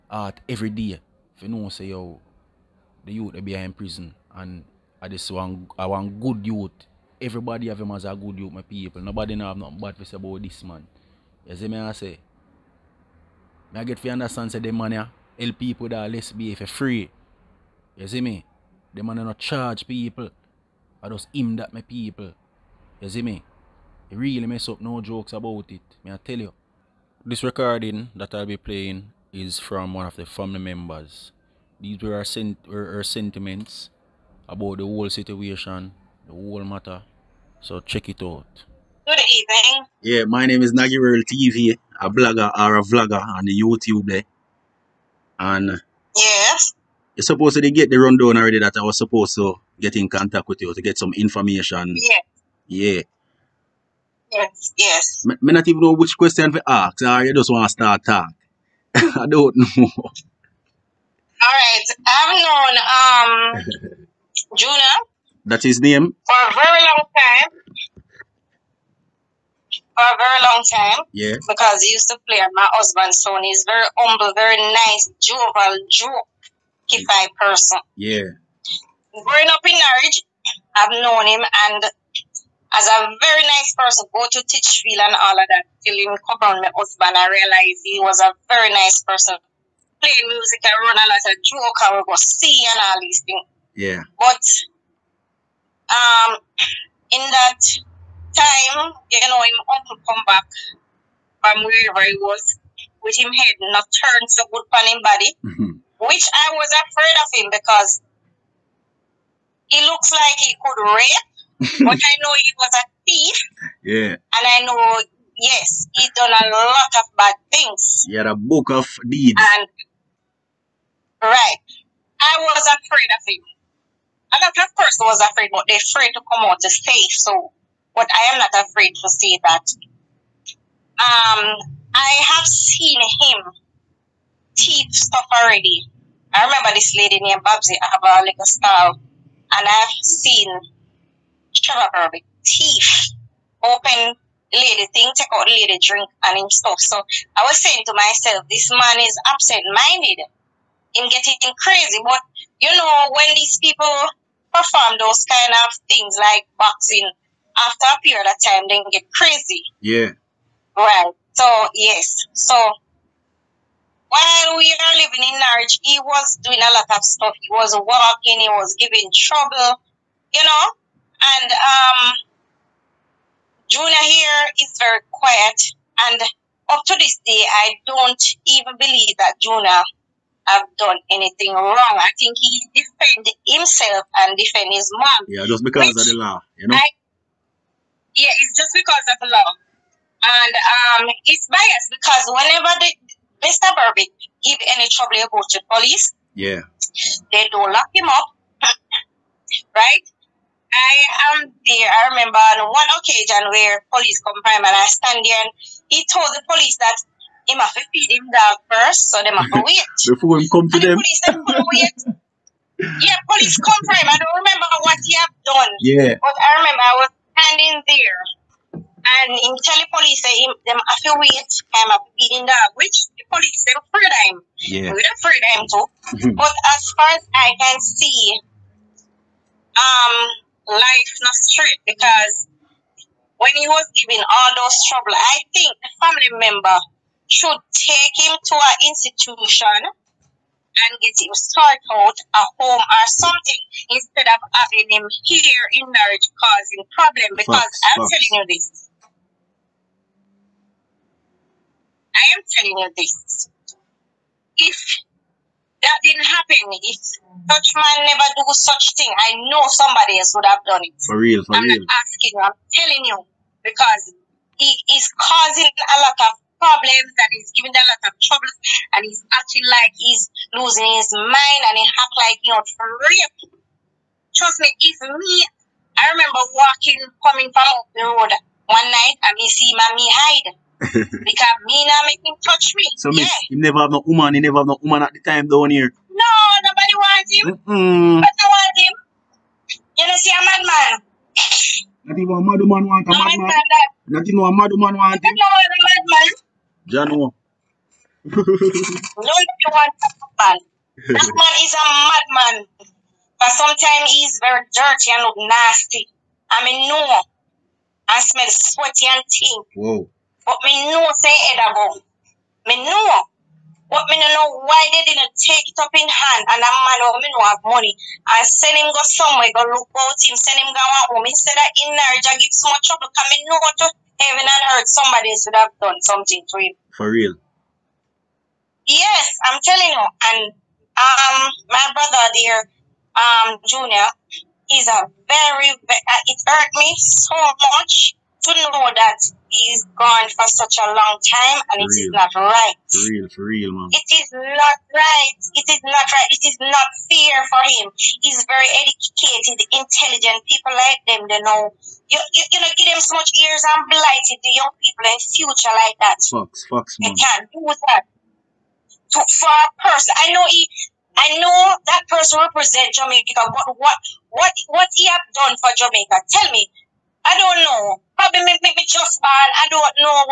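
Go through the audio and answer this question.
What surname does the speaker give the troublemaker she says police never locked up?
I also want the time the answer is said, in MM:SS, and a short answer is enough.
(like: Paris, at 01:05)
Berbick, at 03:13.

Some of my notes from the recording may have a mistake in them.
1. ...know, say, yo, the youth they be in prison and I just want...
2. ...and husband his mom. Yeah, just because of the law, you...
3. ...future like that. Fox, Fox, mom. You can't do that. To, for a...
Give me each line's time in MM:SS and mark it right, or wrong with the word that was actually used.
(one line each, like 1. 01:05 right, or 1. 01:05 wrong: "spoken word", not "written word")
1. 00:01 right
2. 03:04 wrong: "defend", not "husband"
3. 05:55 right.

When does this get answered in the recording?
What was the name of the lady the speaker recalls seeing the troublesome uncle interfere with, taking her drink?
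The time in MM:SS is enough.
02:17.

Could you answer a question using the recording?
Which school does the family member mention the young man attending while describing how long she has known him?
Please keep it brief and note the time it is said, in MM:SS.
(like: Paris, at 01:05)
Titchfield, at 01:24.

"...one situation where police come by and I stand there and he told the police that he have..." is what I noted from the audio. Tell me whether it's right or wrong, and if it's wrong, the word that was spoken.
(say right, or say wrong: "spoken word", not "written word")
wrong: "occasion", not "situation".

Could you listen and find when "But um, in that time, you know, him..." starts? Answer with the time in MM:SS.
01:34.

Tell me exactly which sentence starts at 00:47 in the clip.
You're supposed to get the rundown already that I was supposed to get in contact with you to get some information.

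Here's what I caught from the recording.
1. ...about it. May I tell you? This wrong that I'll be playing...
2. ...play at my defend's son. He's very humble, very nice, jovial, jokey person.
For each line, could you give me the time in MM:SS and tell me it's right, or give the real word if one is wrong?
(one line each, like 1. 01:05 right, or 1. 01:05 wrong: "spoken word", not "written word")
1. 00:25 wrong: "recording", not "wrong"
2. 01:12 wrong: "husband", not "defend".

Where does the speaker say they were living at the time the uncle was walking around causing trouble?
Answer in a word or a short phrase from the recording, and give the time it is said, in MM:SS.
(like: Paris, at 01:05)
Norwich, at 02:45.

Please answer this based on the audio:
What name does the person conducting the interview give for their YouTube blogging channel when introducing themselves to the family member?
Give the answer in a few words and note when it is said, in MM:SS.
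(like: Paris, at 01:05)
Naggy Real TV, at 00:40.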